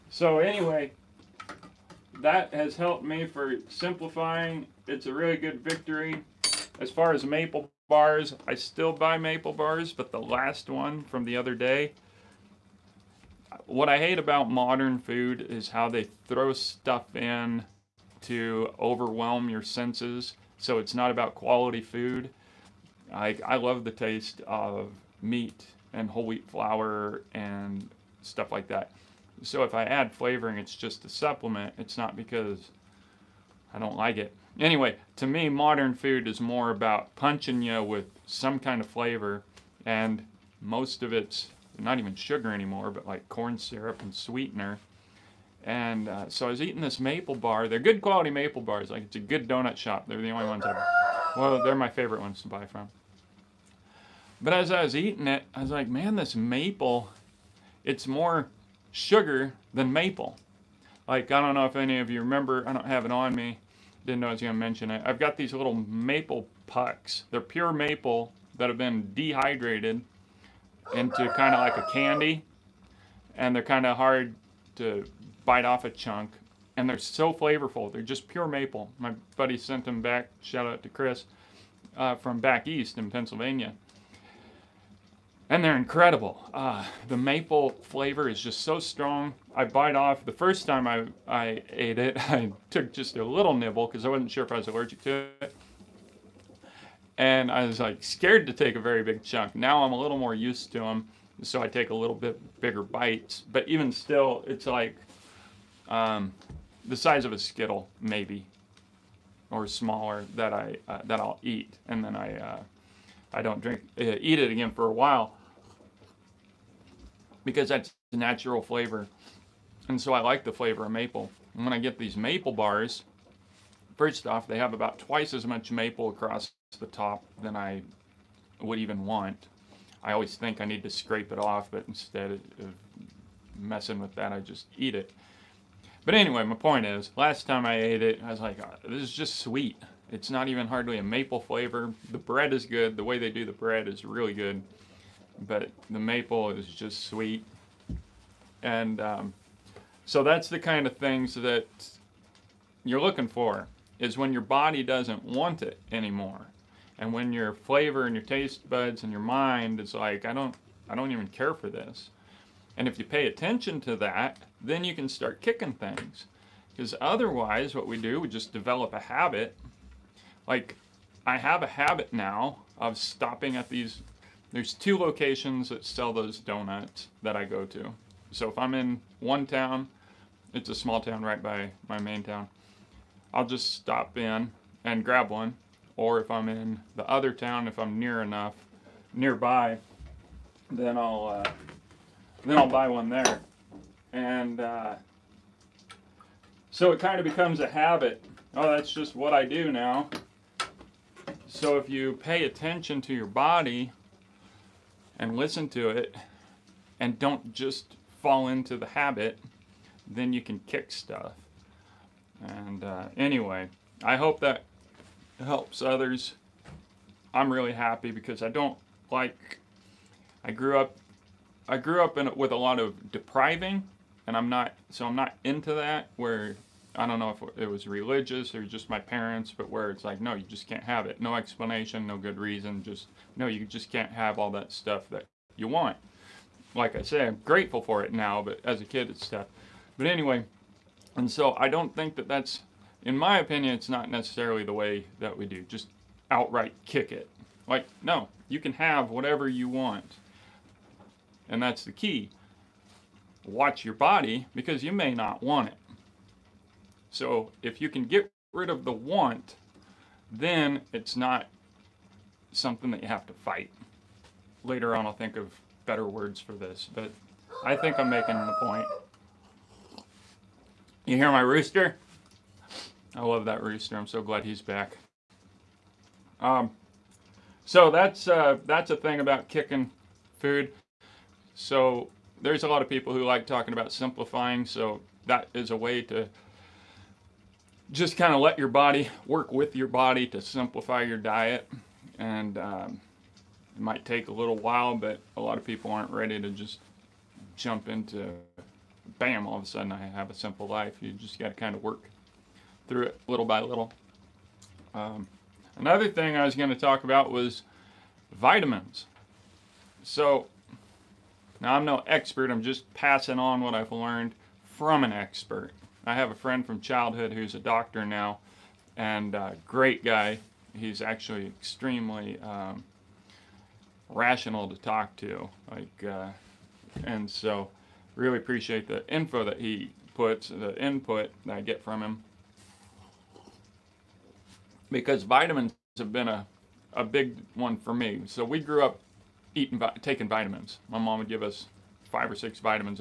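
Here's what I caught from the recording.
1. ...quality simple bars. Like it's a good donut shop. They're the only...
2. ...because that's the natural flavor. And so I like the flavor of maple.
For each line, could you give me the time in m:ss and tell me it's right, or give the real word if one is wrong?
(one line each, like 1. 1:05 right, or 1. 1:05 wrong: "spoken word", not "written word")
1. 0:48 wrong: "maple", not "simple"
2. 1:57 right.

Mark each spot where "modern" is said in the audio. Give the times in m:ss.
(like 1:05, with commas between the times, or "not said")
0:14, 0:35.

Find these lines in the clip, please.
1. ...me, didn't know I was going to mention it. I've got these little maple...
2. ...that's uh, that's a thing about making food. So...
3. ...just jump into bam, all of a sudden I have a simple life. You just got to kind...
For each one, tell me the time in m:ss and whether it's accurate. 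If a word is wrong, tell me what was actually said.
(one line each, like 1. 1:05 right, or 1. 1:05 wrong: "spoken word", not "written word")
1. 1:03 right
2. 4:37 wrong: "kicking", not "making"
3. 4:56 right.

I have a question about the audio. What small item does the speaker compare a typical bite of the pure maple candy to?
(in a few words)
A Skittle.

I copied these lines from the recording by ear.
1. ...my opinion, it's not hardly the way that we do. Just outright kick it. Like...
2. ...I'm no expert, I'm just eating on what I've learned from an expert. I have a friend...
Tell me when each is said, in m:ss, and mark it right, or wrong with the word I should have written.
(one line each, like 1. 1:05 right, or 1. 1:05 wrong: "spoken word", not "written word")
1. 4:03 wrong: "necessarily", not "hardly"
2. 5:11 wrong: "passing", not "eating".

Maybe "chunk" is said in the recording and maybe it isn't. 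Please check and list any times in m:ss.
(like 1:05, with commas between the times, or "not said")
1:15, 1:39.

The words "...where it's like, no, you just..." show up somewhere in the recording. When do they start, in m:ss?
3:49.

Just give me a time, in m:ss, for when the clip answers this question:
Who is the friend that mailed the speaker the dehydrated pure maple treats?
1:20.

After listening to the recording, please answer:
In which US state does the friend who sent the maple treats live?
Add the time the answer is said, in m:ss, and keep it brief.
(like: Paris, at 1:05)
Pennsylvania, at 1:23.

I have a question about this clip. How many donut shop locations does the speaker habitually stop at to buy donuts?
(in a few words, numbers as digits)
2.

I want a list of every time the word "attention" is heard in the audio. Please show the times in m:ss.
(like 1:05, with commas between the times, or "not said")
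2:43, 3:22.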